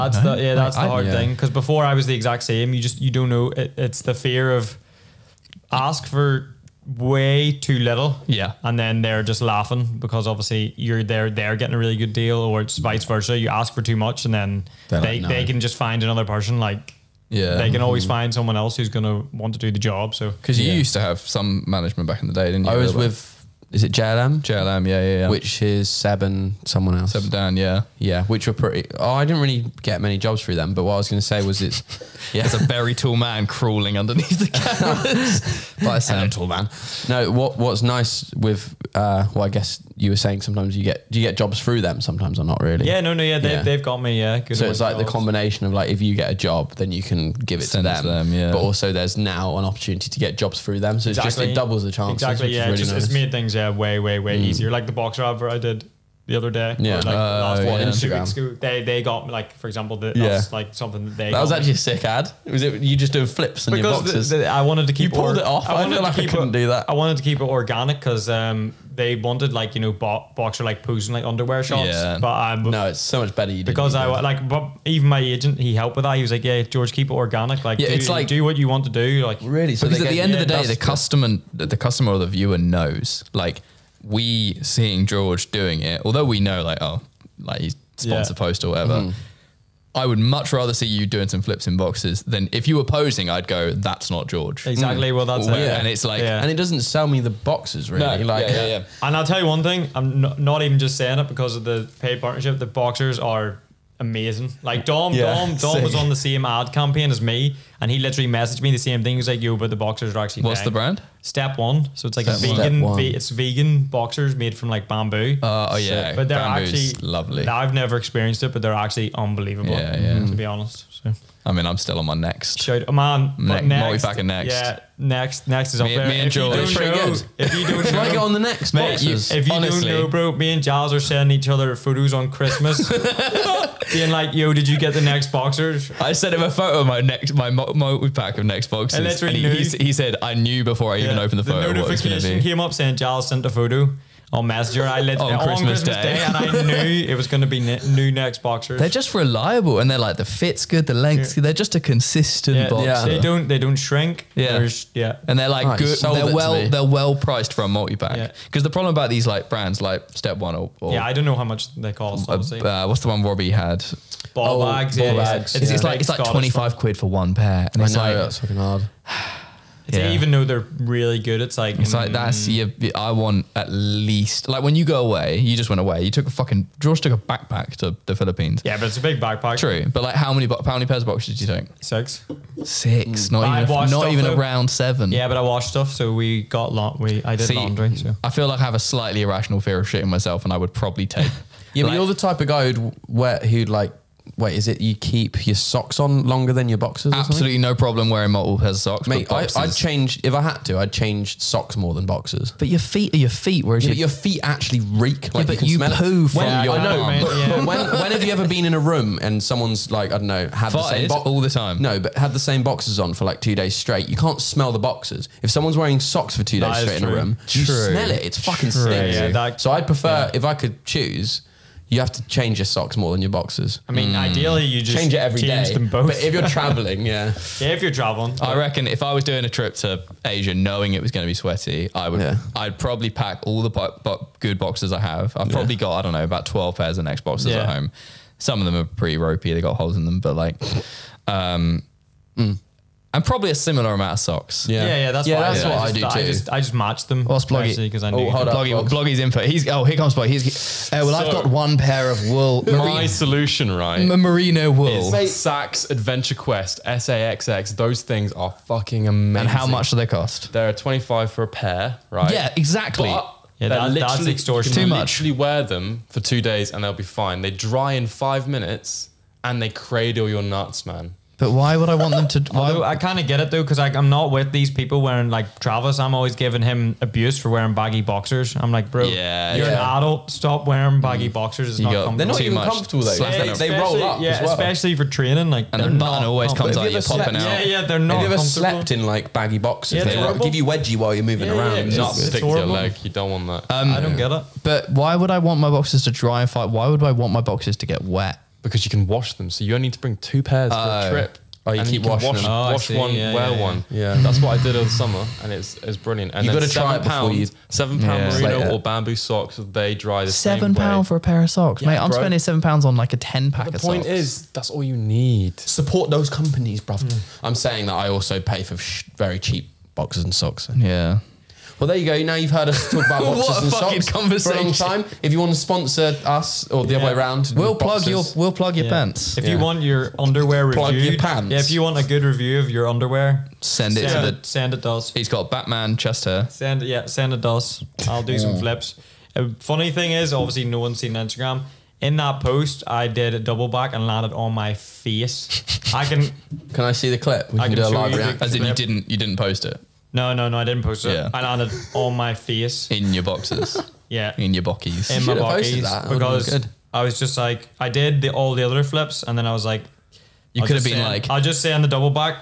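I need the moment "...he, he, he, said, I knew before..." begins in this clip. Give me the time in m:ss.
2:19.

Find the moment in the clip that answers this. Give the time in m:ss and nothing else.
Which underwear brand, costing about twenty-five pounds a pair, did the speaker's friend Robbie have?
2:44.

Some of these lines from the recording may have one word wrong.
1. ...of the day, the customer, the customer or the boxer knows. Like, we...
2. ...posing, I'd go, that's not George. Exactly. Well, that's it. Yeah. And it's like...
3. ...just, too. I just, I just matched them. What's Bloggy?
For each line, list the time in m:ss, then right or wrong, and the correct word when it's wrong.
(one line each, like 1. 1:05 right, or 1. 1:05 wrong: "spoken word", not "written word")
1. 1:20 wrong: "viewer", not "boxer"
2. 1:32 right
3. 4:06 right.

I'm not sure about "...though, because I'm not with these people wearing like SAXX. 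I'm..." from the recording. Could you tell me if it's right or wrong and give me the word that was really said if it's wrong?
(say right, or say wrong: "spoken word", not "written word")
wrong: "Travis", not "SAXX".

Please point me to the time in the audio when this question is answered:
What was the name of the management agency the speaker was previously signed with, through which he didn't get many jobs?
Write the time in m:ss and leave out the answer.
0:23.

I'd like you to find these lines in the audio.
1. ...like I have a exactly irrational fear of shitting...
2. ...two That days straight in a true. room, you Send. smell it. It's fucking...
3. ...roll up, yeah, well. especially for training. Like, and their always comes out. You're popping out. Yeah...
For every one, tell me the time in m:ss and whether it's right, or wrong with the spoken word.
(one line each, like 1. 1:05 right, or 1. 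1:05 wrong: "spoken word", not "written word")
1. 3:08 wrong: "slightly", not "exactly"
2. 3:36 wrong: "True", not "Send"
3. 4:43 right.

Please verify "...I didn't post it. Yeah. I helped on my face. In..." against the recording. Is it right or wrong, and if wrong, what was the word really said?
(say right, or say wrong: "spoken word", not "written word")
wrong: "landed", not "helped".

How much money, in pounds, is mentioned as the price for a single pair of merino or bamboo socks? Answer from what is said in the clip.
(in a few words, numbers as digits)
7 pounds.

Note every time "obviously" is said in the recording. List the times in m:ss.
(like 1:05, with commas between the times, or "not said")
0:10, 5:40.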